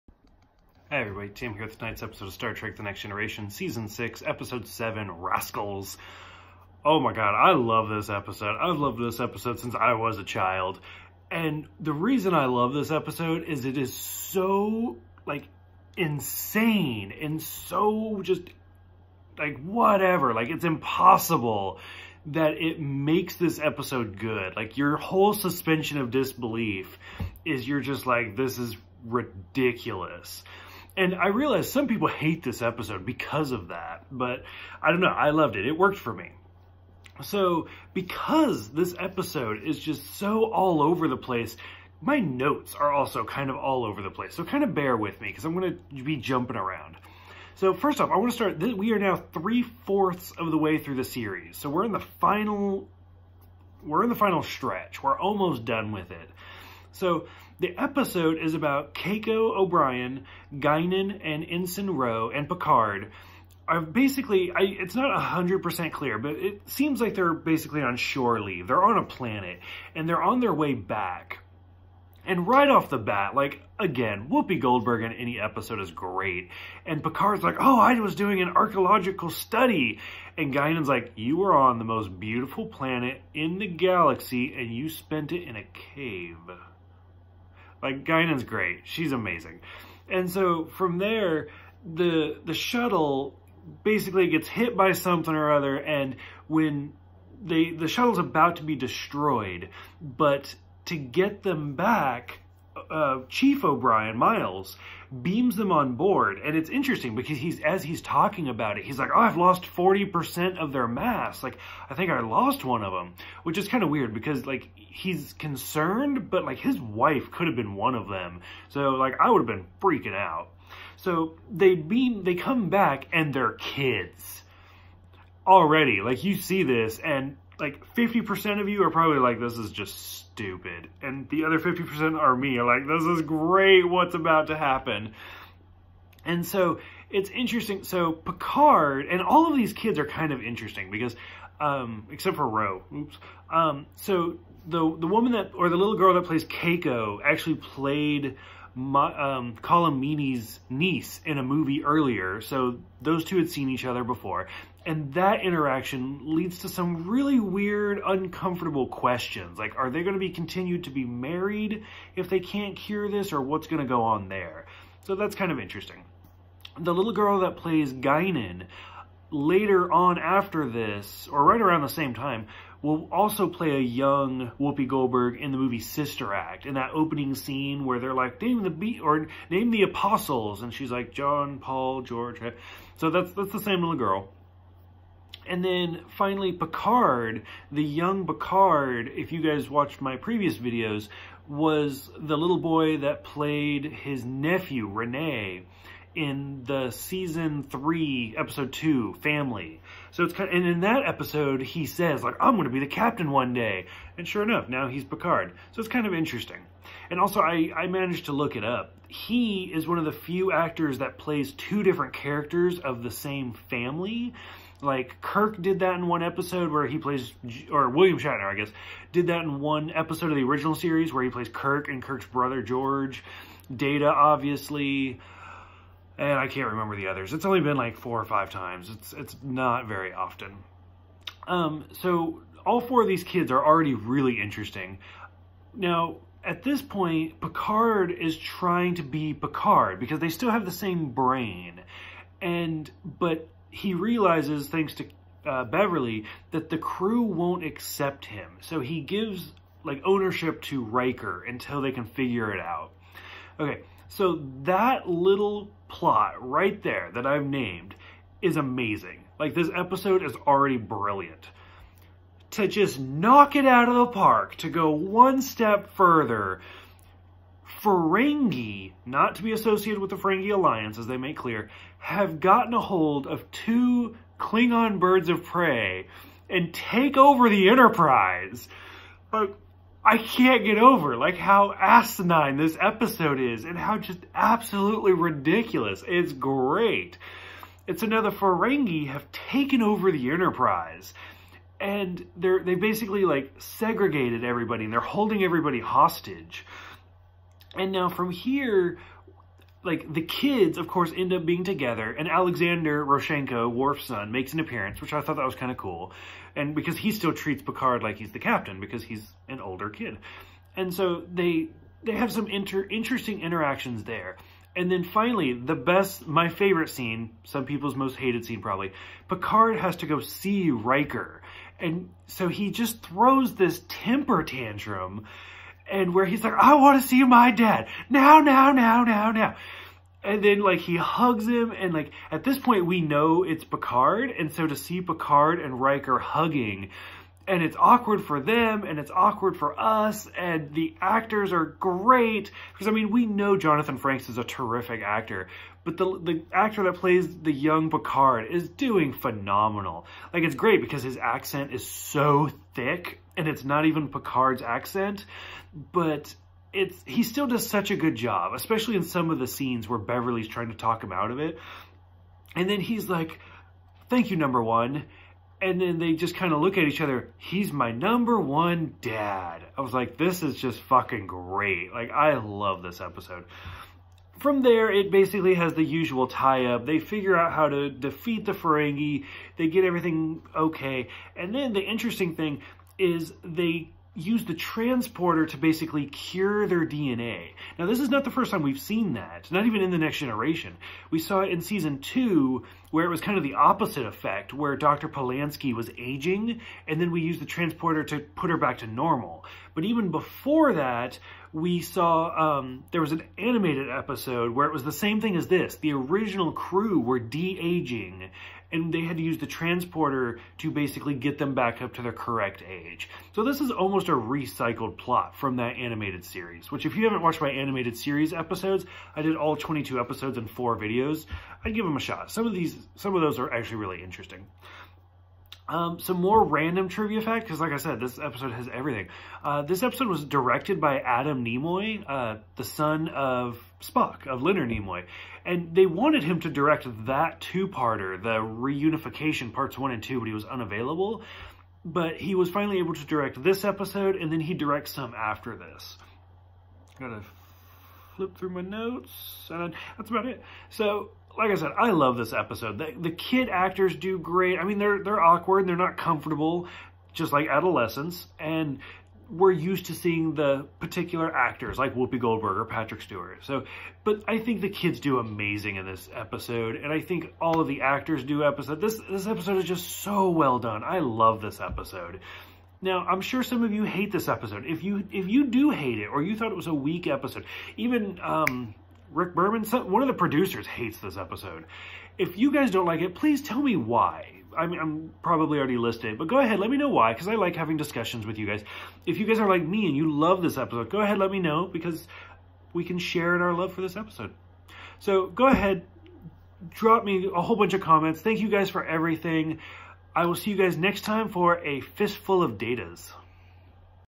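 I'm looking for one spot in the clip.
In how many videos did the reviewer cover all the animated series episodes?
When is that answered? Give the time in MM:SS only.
07:00.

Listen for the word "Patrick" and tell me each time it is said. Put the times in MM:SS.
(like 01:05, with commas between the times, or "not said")
07:42.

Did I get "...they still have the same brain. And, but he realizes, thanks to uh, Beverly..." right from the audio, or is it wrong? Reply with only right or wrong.
right.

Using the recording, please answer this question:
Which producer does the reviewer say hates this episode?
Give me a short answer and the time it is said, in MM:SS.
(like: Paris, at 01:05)
Rick Berman, at 07:59.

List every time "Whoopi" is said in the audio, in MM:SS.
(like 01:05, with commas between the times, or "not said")
01:14, 02:54, 07:41.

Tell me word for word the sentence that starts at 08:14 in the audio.
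So go ahead, drop me a whole bunch of comments.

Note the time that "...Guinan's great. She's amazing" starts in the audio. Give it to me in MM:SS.
01:28.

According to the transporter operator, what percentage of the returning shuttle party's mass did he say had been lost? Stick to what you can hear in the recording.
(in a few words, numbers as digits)
40%.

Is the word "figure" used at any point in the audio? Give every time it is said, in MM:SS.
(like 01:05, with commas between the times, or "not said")
04:12, 06:16.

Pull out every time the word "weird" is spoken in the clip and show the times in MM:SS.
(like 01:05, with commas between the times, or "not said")
01:53, 02:37.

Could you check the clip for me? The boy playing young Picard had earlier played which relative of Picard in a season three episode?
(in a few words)
Rene.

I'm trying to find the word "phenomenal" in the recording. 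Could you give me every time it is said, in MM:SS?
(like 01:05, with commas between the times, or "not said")
05:49.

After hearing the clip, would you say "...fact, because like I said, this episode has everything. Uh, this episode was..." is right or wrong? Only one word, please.
right.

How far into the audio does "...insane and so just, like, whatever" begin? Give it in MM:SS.
00:15.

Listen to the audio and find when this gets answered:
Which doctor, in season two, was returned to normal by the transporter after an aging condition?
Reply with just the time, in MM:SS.
06:34.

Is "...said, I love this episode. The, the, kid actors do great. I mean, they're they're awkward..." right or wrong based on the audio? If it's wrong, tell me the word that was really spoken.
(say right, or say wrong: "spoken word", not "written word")
right.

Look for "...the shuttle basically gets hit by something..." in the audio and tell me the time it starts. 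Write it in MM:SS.
01:32.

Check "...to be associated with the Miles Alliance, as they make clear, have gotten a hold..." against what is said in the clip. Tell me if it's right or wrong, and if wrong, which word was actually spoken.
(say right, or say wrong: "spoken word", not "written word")
wrong: "Ferengi", not "Miles".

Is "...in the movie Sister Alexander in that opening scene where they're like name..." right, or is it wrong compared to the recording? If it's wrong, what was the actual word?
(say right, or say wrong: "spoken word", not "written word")
wrong: "Act", not "Alexander".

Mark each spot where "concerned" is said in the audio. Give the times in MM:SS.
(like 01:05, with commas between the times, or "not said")
01:55.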